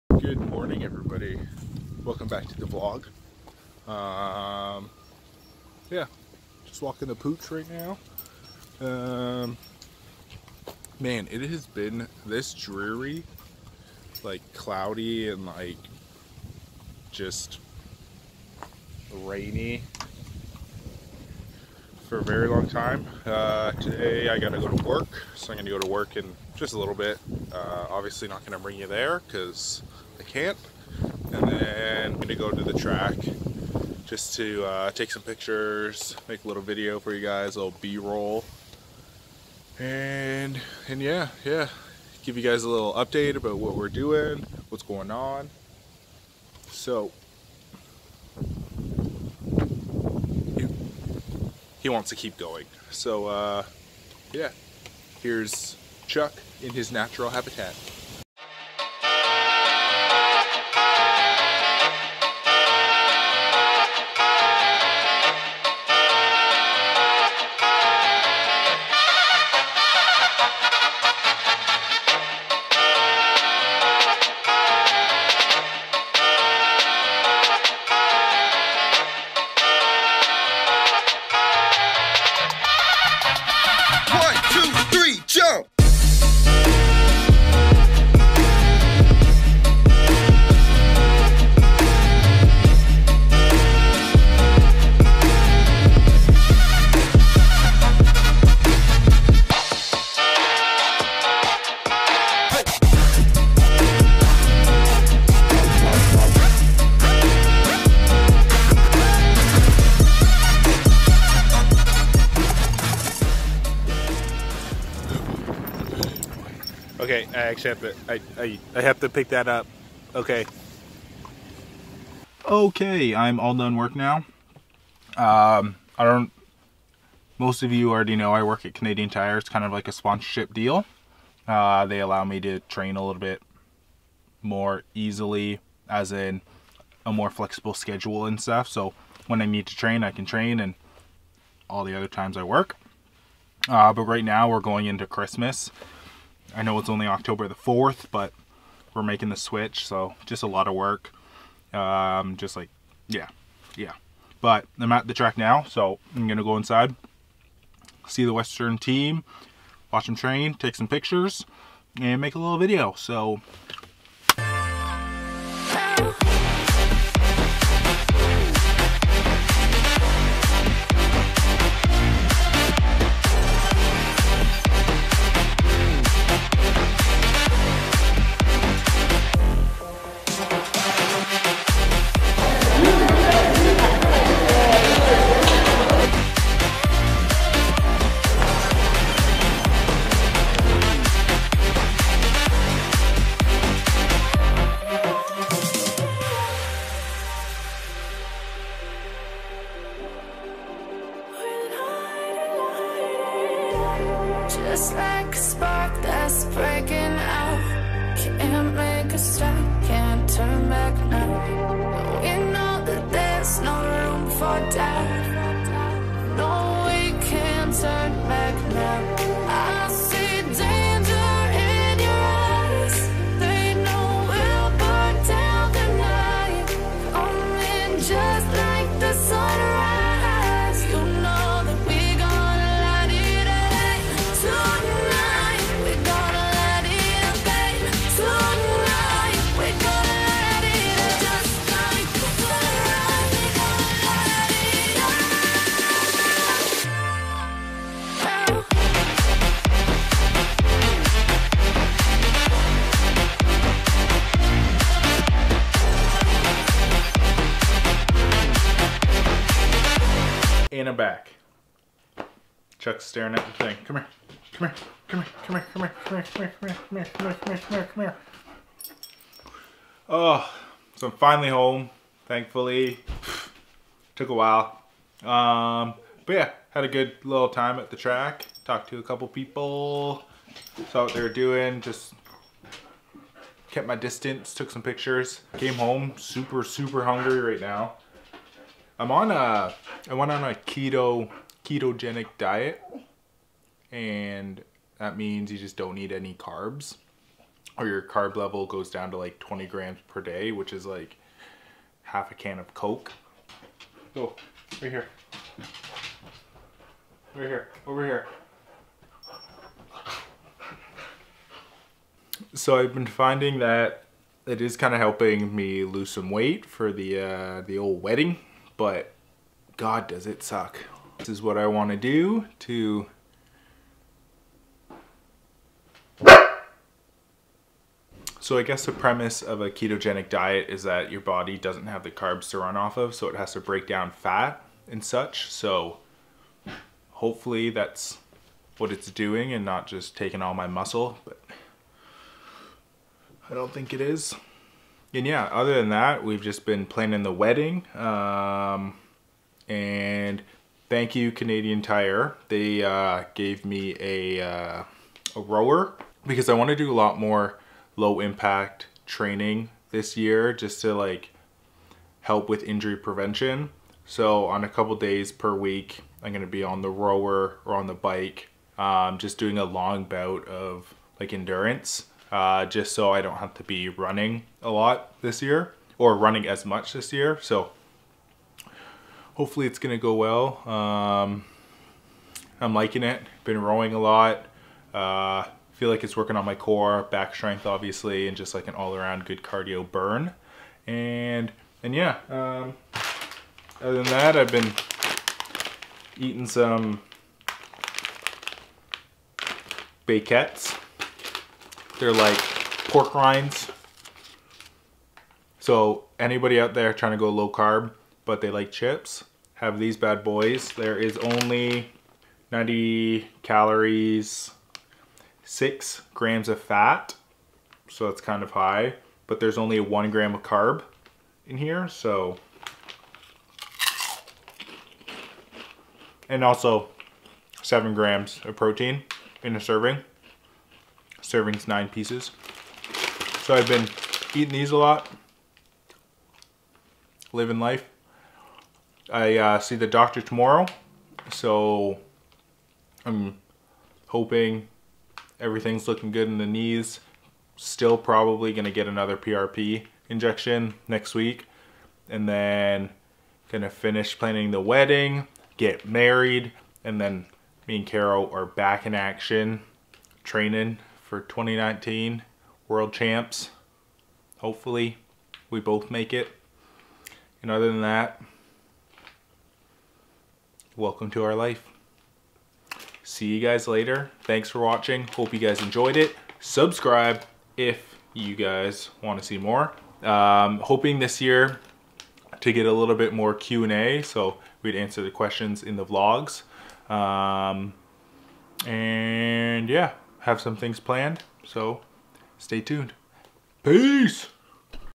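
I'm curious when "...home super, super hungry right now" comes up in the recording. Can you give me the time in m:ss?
4:45.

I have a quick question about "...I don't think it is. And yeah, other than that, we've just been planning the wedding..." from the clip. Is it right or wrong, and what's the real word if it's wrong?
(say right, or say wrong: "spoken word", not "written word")
right.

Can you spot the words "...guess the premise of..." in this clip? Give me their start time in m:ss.
5:28.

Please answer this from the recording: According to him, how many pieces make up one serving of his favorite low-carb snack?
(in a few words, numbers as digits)
9.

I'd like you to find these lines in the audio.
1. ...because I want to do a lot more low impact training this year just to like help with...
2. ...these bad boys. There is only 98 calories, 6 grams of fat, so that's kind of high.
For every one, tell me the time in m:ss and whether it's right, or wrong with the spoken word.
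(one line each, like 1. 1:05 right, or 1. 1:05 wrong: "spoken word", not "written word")
1. 5:56 right
2. 6:49 wrong: "90", not "98".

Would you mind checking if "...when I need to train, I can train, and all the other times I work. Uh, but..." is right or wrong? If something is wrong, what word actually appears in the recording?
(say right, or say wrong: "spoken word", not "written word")
right.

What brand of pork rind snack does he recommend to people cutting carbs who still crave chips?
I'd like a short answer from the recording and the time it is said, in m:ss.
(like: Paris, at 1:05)
Baken-ets, at 6:40.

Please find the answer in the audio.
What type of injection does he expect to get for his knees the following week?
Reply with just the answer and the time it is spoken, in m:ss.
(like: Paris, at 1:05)
PRP, at 7:29.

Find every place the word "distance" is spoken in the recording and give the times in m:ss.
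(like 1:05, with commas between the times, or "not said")
4:43.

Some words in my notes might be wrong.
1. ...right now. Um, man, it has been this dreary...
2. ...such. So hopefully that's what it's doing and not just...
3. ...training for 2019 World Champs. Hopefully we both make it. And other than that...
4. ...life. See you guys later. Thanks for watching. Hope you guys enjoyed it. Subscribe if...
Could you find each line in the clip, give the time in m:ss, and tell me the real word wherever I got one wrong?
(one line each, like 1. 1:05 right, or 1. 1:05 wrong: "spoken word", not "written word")
1. 0:07 right
2. 5:35 right
3. 7:40 right
4. 7:51 right.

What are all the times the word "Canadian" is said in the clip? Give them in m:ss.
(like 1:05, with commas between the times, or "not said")
2:08, 5:51.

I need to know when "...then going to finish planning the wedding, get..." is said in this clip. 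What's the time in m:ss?
7:32.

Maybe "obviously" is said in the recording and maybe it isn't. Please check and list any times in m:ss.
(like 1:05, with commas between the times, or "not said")
0:27, 6:27.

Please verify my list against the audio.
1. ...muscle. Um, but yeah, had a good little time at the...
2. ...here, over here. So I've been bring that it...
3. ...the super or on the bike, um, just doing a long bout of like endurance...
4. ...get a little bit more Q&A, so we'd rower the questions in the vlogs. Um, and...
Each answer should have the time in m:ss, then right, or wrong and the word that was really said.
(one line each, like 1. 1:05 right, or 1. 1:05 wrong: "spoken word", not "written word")
1. 4:34 wrong: "while", not "muscle"
2. 5:07 wrong: "finding", not "bring"
3. 6:06 wrong: "rower", not "super"
4. 8:02 wrong: "answer", not "rower".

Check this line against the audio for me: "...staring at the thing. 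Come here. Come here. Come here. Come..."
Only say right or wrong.
right.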